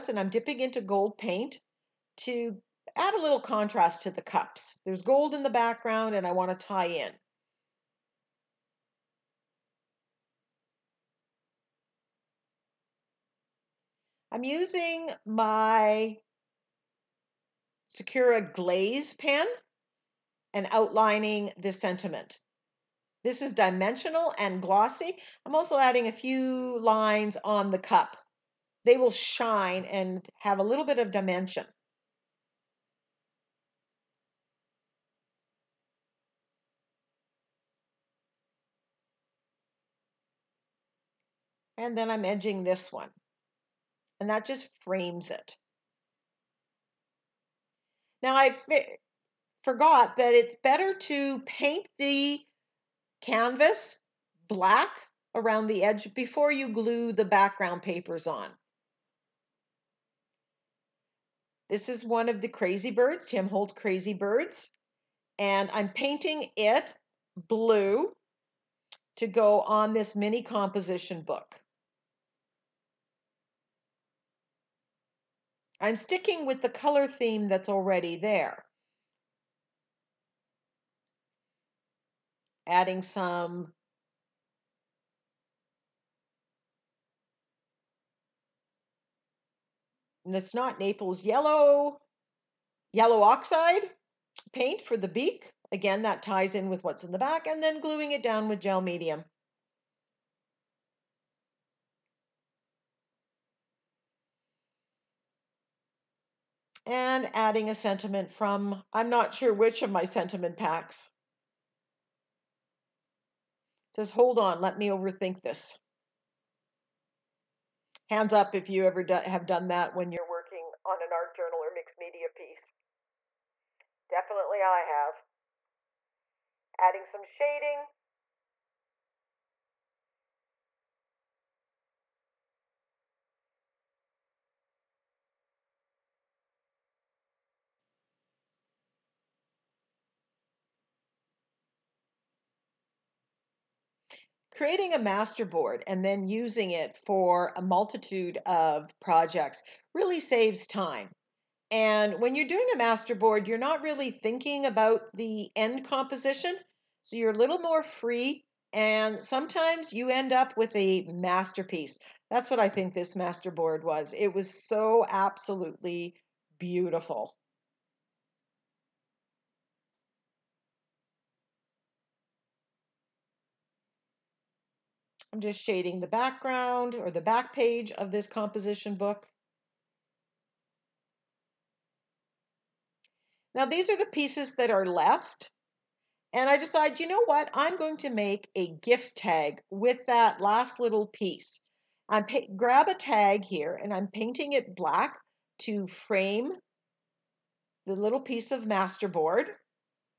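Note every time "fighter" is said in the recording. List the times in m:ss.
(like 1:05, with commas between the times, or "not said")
not said.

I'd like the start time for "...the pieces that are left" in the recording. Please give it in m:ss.
3:03.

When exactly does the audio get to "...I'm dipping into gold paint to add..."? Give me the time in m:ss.
0:00.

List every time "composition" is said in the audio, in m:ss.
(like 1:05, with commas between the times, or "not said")
1:10, 2:35, 2:58.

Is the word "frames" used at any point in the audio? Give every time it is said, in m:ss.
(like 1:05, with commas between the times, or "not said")
0:44, 3:15.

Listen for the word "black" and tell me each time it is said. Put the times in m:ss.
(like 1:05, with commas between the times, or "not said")
0:54, 3:14.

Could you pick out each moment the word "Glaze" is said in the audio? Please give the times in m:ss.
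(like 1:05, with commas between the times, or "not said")
0:18.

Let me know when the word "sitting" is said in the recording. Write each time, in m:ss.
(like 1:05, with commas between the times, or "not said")
not said.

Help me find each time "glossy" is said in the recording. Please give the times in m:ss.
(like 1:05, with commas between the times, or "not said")
0:24.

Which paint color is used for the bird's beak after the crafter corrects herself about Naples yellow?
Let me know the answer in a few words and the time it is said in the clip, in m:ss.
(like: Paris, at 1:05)
yellow oxide, at 1:32.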